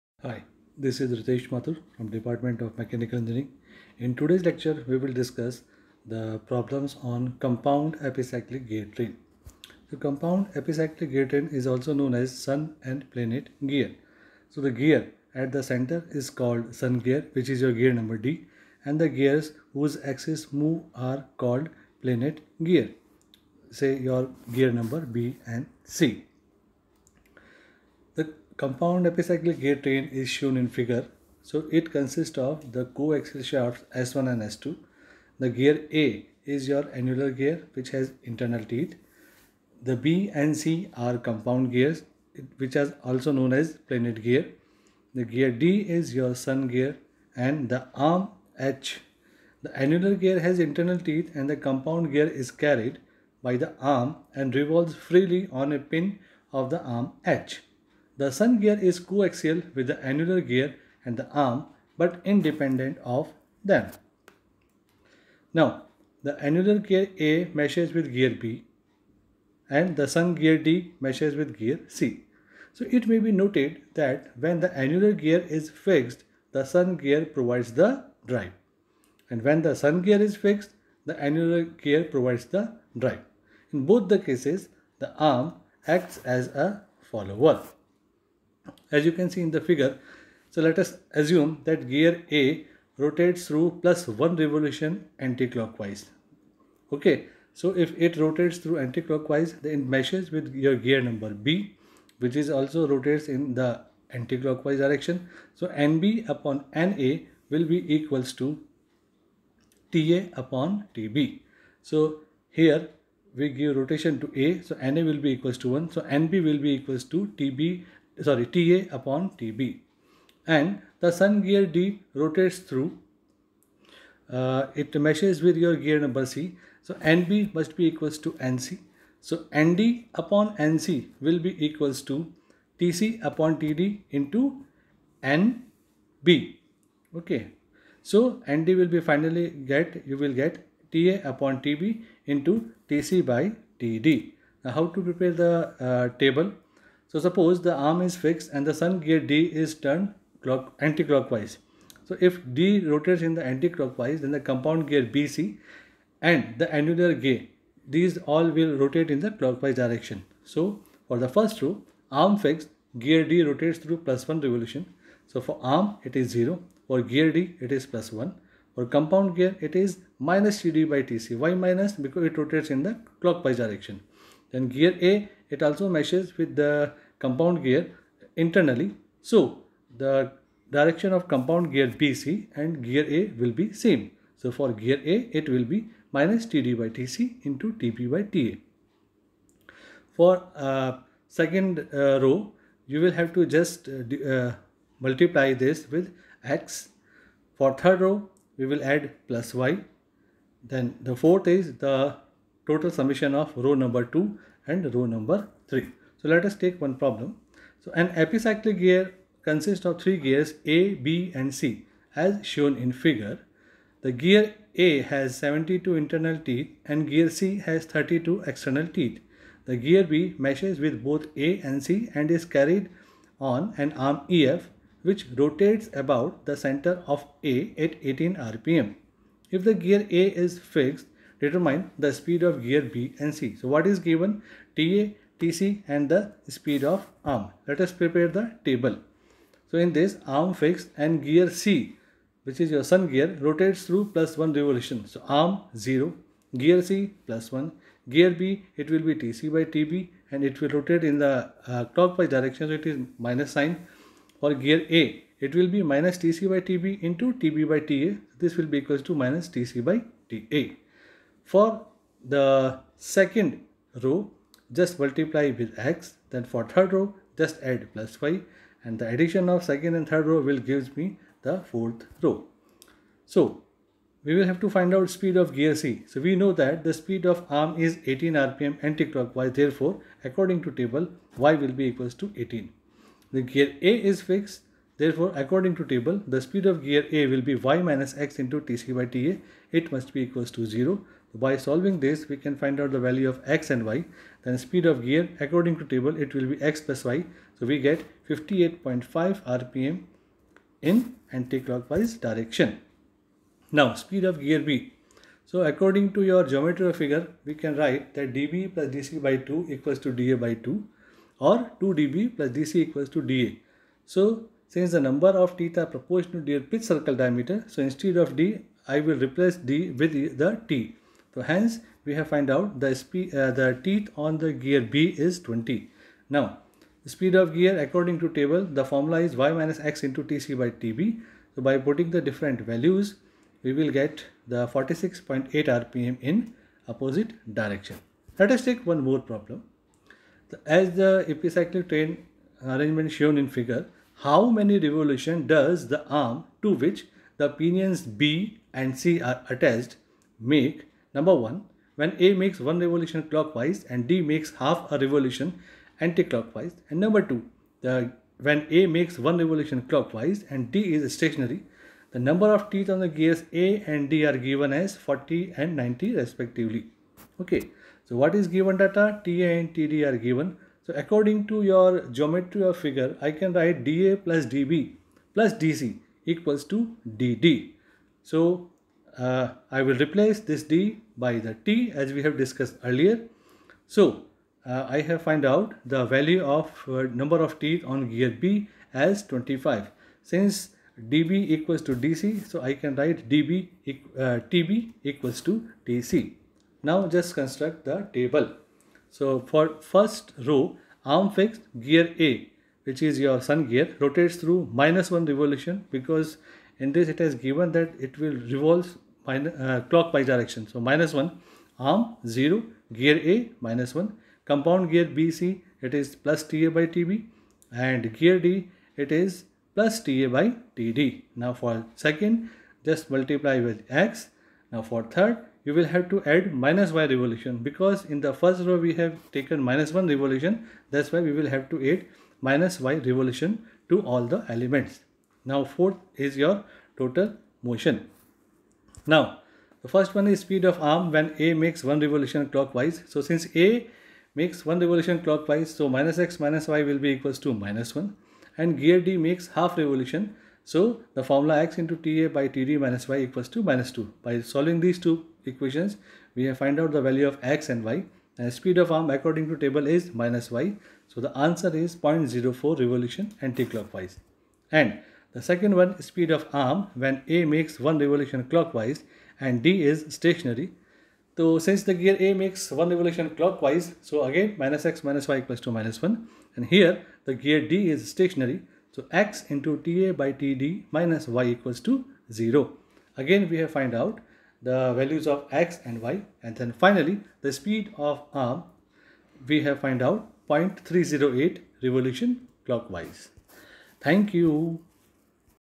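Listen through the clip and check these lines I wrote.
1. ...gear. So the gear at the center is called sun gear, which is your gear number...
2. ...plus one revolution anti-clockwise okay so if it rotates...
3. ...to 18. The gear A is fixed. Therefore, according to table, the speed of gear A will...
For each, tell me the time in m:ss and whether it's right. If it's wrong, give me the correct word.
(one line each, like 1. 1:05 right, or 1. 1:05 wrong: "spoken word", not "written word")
1. 0:13 right
2. 1:33 right
3. 4:42 right.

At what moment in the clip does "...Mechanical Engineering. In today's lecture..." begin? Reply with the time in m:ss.
0:02.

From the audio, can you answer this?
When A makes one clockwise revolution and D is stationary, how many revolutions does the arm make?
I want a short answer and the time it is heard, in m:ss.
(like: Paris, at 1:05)
0.308 revolution clockwise, at 8:10.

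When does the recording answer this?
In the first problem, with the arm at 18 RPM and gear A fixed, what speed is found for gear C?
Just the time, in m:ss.
4:58.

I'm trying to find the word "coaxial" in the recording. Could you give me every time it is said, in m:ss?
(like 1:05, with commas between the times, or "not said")
0:32, 0:58.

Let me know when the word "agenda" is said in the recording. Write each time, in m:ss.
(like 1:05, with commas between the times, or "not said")
not said.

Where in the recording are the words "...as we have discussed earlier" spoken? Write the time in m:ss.
6:21.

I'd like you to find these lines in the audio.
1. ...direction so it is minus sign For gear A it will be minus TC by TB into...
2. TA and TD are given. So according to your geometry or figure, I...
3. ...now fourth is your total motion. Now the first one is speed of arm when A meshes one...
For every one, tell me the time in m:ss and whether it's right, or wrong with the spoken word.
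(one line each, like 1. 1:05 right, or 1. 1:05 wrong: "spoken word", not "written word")
1. 4:12 right
2. 6:09 right
3. 7:15 wrong: "makes", not "meshes".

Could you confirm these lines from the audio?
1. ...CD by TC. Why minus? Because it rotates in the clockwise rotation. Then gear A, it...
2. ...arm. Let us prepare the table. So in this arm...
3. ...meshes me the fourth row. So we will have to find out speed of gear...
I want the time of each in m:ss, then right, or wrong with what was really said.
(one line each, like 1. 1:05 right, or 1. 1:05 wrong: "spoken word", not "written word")
1. 2:50 wrong: "direction", not "rotation"
2. 3:57 right
3. 4:30 wrong: "gives", not "meshes".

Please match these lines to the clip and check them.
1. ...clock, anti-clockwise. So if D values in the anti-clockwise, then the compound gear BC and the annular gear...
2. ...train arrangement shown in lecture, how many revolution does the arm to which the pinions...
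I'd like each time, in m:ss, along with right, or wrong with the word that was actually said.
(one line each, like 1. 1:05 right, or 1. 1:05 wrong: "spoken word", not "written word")
1. 2:30 wrong: "rotates", not "values"
2. 5:41 wrong: "figure", not "lecture".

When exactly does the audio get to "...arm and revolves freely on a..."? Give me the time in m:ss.
0:53.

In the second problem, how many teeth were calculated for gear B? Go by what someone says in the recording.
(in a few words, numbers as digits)
25.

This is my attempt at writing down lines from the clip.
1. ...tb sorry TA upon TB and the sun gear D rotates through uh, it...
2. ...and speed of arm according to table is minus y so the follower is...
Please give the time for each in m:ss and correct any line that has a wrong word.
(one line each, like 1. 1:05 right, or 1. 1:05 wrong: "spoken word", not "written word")
1. 1:57 right
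2. 7:38 wrong: "answer", not "follower".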